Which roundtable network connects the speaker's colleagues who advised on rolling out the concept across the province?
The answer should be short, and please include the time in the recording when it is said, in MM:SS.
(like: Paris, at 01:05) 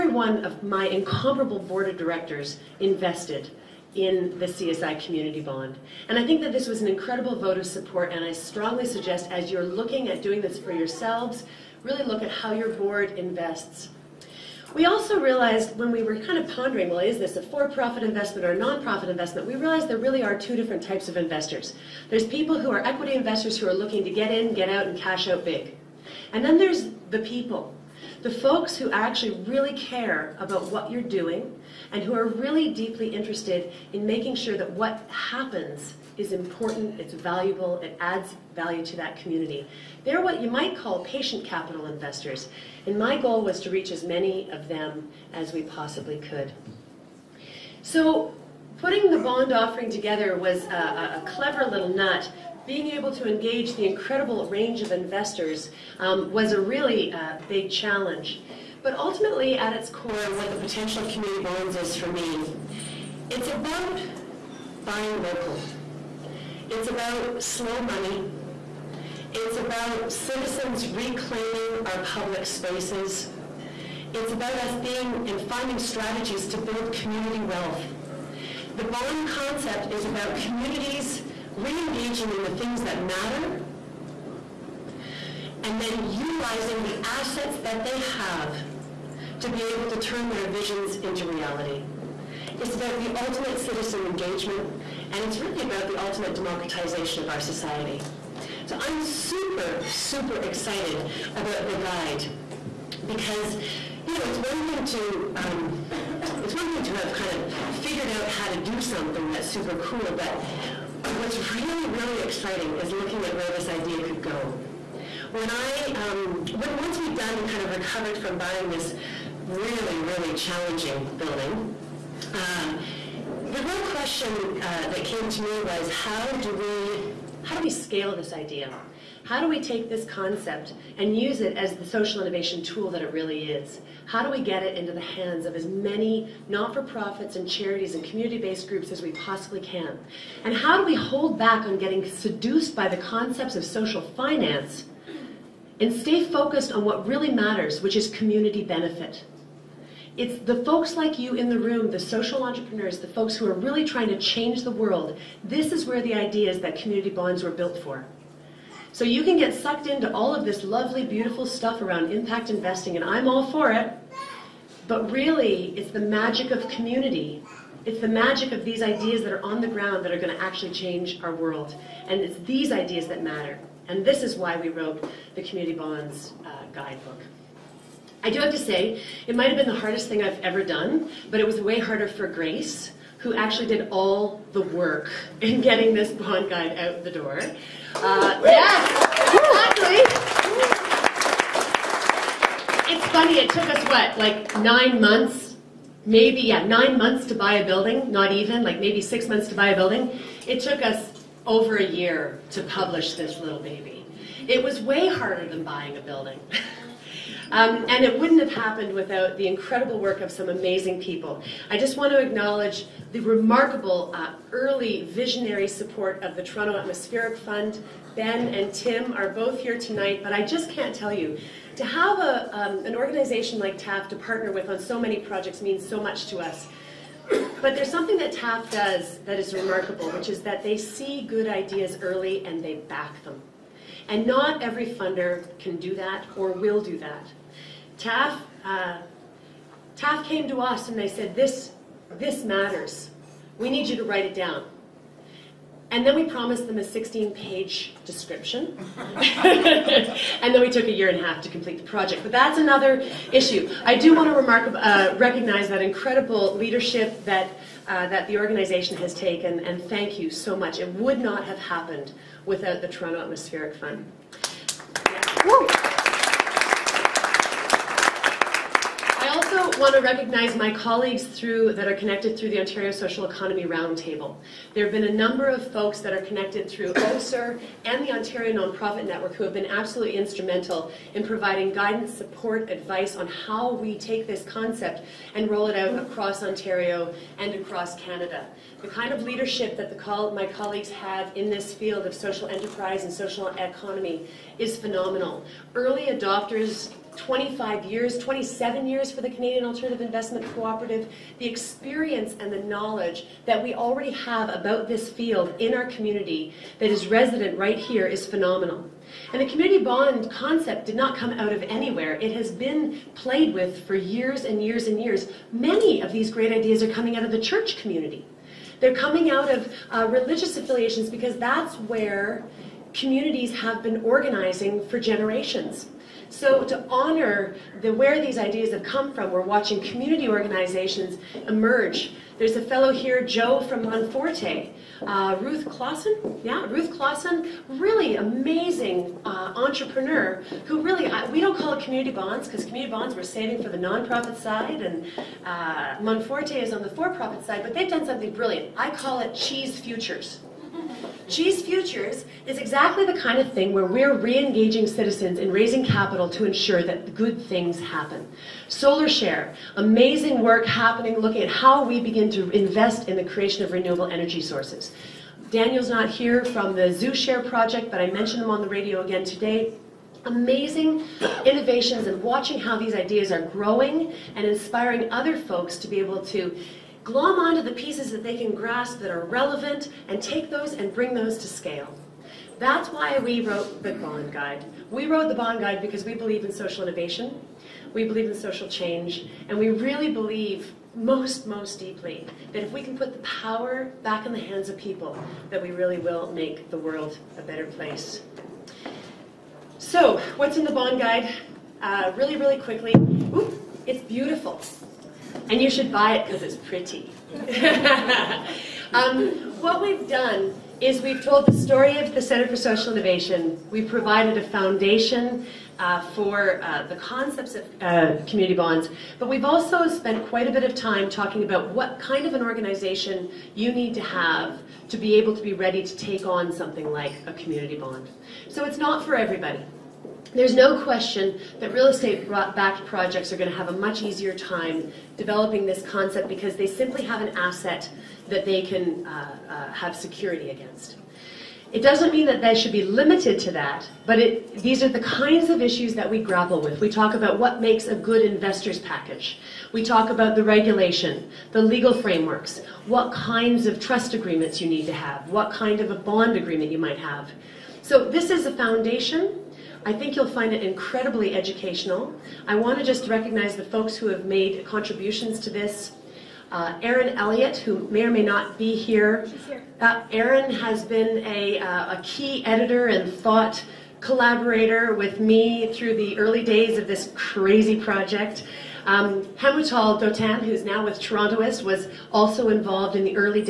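Ontario Social Economy Roundtable, at 04:32.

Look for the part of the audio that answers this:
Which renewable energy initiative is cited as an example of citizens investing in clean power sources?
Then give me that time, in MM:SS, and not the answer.
05:58.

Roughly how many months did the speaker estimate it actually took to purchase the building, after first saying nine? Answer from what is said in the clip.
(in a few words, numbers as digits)
6 months.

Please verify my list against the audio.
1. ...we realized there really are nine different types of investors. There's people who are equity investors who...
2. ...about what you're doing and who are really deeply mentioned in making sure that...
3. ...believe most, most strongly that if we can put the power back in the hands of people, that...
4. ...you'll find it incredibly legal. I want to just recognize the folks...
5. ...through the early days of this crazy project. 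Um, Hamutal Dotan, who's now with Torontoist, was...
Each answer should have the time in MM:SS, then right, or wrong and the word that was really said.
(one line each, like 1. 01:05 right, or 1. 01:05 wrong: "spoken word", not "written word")
1. 00:19 wrong: "two", not "nine"
2. 00:30 wrong: "interested", not "mentioned"
3. 06:30 wrong: "deeply", not "strongly"
4. 07:40 wrong: "educational", not "legal"
5. 07:55 right.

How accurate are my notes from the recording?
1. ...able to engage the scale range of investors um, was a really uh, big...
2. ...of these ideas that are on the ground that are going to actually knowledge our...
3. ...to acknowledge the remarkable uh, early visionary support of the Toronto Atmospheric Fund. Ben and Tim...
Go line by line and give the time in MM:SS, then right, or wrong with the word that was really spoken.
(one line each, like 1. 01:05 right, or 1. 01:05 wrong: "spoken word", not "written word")
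1. 00:52 wrong: "incredible", not "scale"
2. 02:48 wrong: "change", not "knowledge"
3. 03:32 right.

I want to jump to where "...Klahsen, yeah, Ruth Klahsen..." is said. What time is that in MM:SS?
05:35.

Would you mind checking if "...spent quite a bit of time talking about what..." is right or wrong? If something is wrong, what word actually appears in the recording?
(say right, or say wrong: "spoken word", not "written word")
right.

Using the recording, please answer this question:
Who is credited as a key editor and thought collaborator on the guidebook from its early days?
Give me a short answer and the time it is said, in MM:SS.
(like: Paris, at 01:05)
Erin Elliott, at 07:46.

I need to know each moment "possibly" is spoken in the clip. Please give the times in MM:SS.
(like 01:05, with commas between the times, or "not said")
00:45, 02:19.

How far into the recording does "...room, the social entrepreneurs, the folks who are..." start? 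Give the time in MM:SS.
02:31.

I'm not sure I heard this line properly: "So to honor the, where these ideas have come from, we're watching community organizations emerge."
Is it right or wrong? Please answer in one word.
right.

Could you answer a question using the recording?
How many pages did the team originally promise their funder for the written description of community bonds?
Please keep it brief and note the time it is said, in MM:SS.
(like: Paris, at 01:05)
16, at 04:06.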